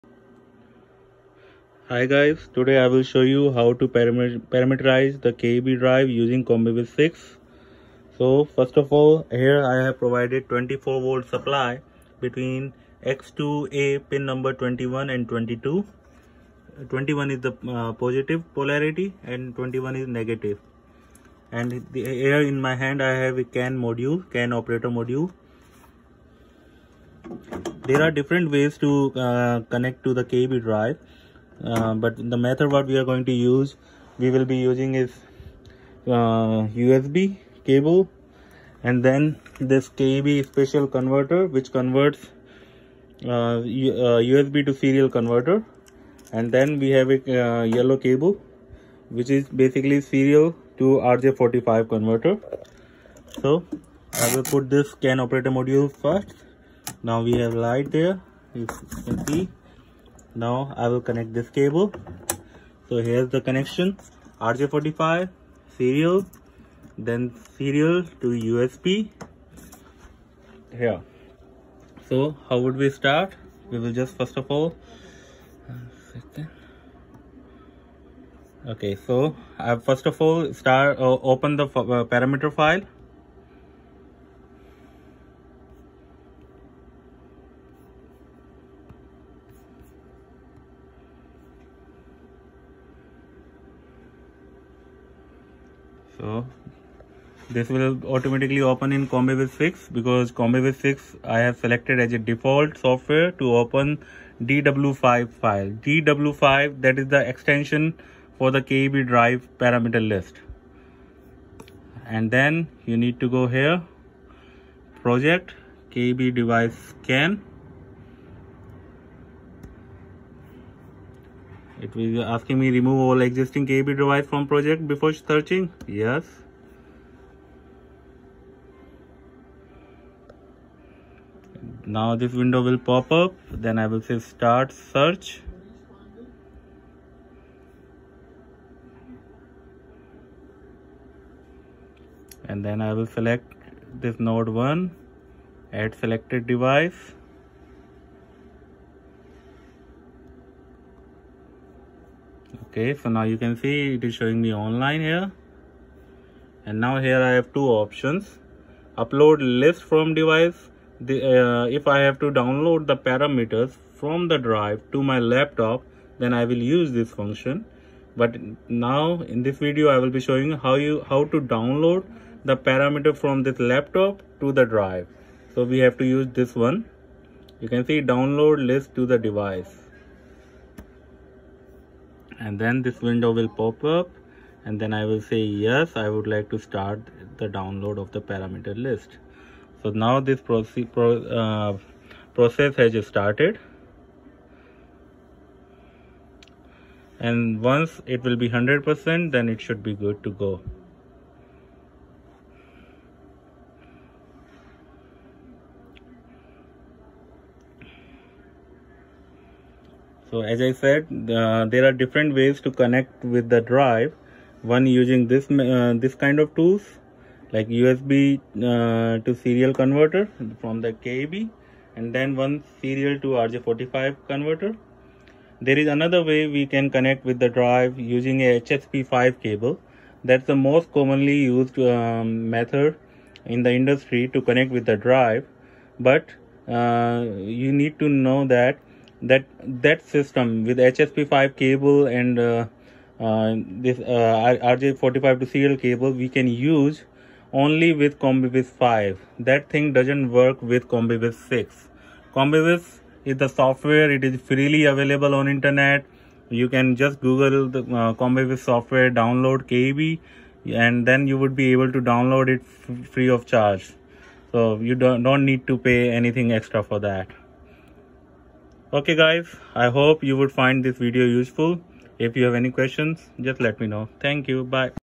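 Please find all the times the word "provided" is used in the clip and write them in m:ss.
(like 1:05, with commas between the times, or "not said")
0:09.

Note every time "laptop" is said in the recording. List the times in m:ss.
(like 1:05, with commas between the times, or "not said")
2:45, 2:53.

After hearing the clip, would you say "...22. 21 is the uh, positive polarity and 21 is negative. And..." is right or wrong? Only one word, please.
right.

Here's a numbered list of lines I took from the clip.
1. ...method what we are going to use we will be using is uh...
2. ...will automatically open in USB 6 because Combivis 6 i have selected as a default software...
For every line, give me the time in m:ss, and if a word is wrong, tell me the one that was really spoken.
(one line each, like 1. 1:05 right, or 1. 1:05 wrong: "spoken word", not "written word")
1. 0:32 right
2. 1:37 wrong: "Combivis", not "USB".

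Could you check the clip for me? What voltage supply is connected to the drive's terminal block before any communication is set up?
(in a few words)
24 volt.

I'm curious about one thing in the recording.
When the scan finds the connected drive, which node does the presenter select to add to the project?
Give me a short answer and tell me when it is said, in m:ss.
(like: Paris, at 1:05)
node 1, at 2:24.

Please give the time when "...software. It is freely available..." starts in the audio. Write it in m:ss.
4:13.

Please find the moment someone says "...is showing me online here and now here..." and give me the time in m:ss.
2:34.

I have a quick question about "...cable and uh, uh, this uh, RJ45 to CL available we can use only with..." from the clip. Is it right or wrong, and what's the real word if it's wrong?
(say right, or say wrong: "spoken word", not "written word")
wrong: "cable", not "available".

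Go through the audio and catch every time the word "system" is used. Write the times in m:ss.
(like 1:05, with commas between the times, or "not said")
4:00.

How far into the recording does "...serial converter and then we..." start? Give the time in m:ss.
0:44.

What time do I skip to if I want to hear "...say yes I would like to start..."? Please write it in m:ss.
3:05.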